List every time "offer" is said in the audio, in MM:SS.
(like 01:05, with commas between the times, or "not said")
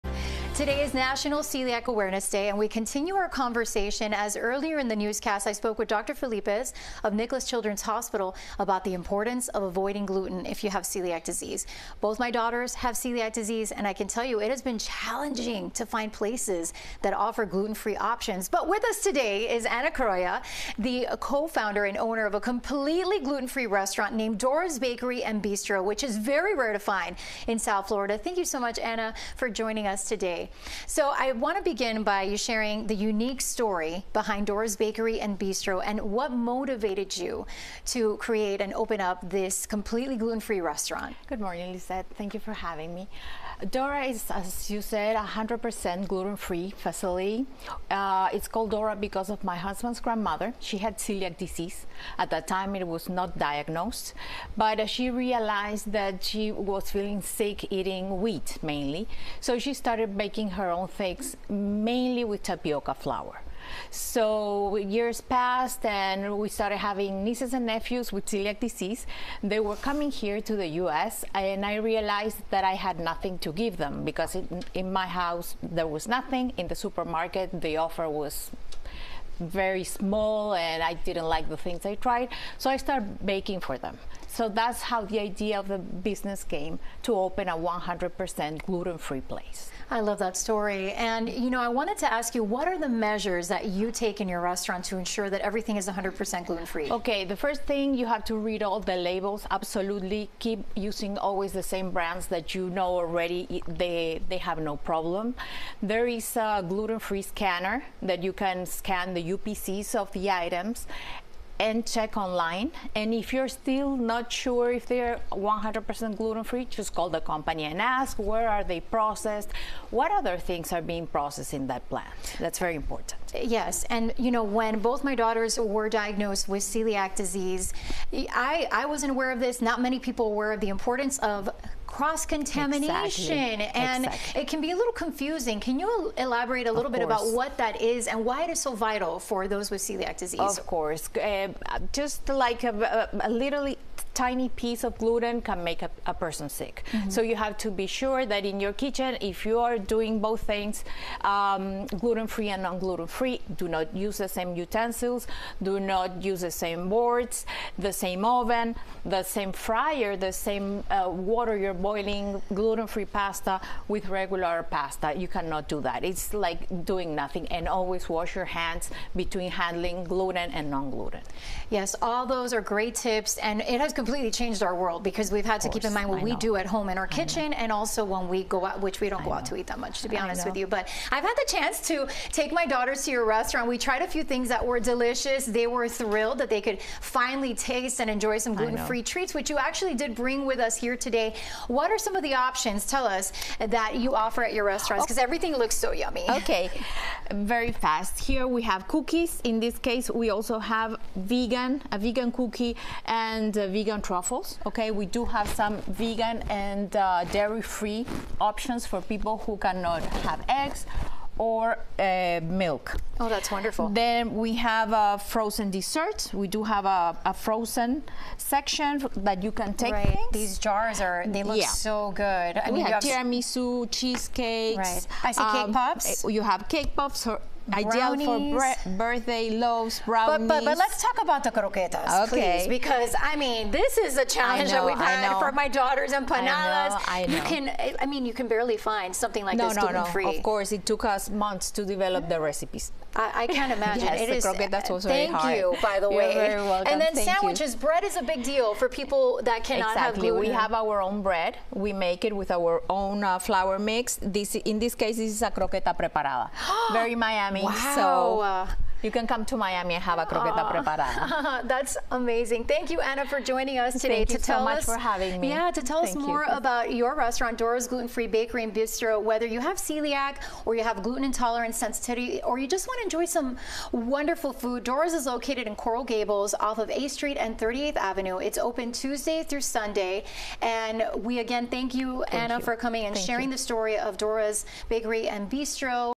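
00:17, 01:17, 03:14.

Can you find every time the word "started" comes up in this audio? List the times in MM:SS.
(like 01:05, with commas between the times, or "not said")
00:59, 01:06, 01:22.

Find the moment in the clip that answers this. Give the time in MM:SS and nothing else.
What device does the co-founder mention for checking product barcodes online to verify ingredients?
01:46.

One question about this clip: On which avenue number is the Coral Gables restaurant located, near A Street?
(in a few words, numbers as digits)
38th Avenue.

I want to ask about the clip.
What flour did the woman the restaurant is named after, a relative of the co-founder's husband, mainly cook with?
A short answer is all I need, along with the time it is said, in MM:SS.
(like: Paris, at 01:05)
tapioca flour, at 01:02.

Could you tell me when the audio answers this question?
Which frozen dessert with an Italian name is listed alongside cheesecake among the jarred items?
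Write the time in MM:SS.
03:43.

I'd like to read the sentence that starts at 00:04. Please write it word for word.
As earlier in the newscast, I spoke with Dr.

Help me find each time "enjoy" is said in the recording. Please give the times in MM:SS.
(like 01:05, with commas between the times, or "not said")
03:08, 04:33.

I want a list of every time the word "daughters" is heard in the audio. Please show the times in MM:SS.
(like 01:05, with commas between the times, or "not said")
00:12, 02:05, 03:02, 03:55.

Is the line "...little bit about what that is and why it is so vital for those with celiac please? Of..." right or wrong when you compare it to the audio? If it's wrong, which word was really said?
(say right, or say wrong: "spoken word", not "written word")
wrong: "disease", not "please".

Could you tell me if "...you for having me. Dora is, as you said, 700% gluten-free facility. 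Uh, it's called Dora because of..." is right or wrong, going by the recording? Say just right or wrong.
wrong.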